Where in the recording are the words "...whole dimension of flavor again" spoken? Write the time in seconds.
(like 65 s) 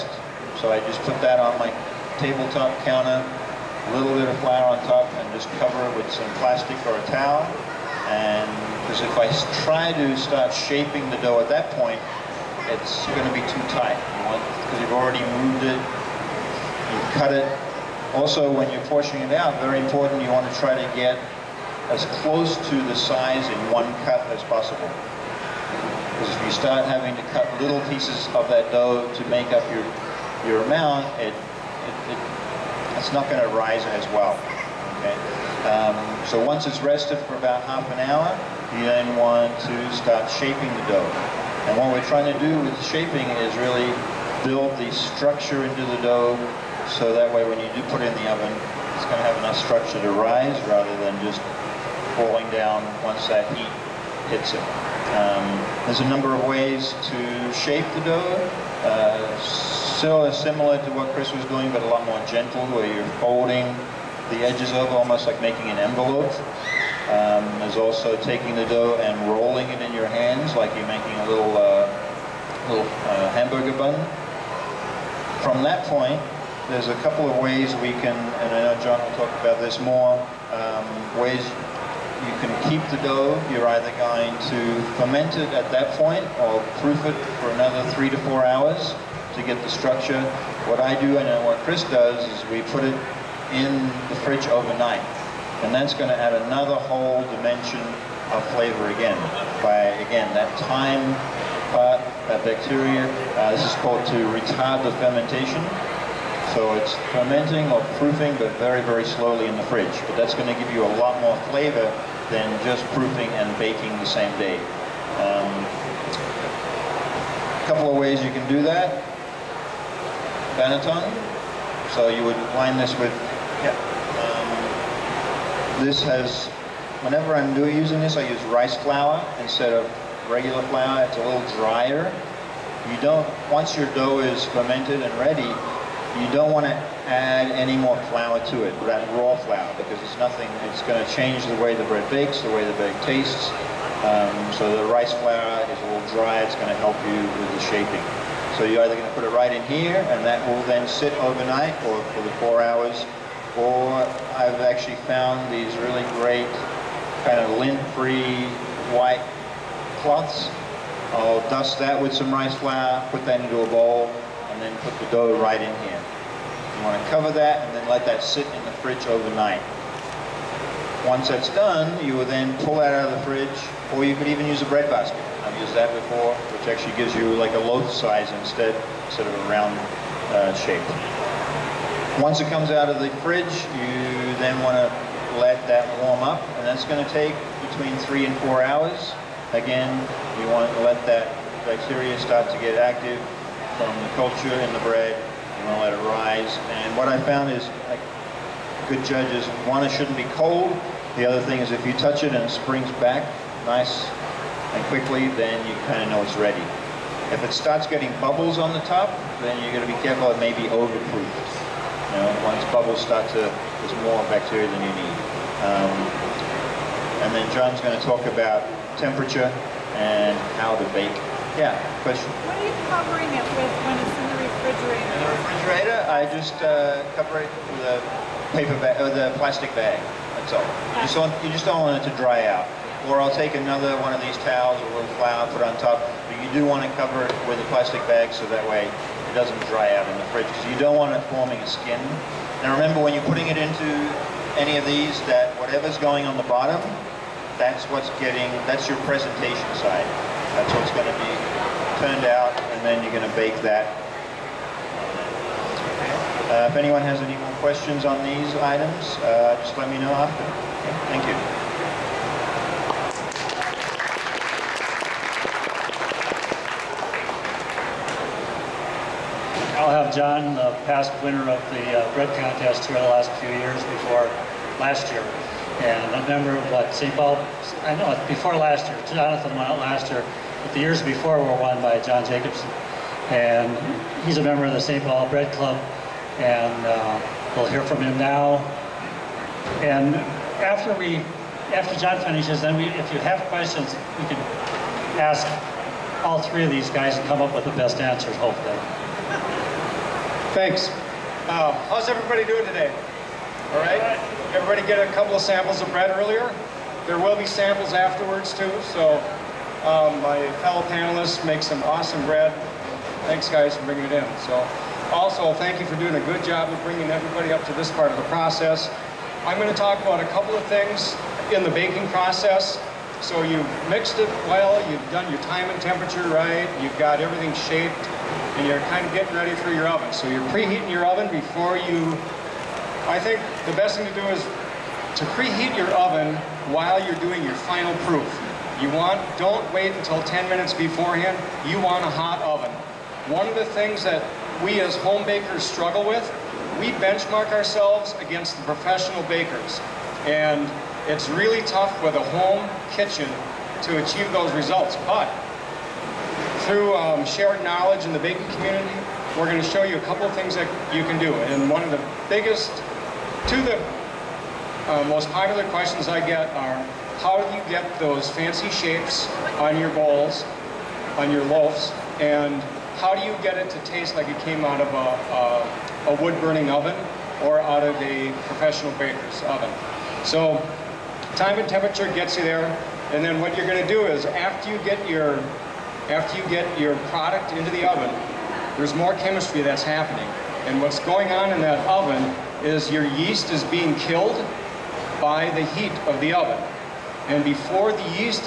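96 s.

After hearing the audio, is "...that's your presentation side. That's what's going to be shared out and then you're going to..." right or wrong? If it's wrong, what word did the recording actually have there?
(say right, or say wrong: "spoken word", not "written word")
wrong: "turned", not "shared".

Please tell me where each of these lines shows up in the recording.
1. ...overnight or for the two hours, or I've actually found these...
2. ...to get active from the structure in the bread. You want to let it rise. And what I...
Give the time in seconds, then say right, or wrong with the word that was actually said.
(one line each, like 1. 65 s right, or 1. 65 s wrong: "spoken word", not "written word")
1. 151 s wrong: "four", not "two"
2. 192 s wrong: "culture", not "structure".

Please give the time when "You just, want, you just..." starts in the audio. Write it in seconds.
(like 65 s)
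230 s.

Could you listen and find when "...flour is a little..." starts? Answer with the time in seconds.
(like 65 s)
145 s.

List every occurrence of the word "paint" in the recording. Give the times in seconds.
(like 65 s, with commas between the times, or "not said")
not said.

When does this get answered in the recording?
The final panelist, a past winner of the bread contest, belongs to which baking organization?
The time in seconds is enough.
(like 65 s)
284 s.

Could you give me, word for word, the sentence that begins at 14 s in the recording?
Because you have already moved it, you've cut it.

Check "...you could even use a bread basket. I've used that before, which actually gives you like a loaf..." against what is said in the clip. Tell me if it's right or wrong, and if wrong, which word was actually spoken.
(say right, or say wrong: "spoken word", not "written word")
right.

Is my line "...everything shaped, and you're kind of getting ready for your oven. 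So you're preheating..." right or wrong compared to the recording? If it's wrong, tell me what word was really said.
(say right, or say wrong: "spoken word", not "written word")
right.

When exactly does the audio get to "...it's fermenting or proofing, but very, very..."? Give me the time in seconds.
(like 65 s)
106 s.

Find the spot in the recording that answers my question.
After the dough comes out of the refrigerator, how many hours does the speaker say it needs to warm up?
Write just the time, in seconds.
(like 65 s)
188 s.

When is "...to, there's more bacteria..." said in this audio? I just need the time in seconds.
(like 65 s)
213 s.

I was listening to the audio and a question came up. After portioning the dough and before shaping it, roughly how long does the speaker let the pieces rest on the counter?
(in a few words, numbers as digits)
half an hour.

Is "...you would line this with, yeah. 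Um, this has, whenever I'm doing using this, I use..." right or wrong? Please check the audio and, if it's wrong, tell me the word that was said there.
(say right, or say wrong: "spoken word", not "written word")
right.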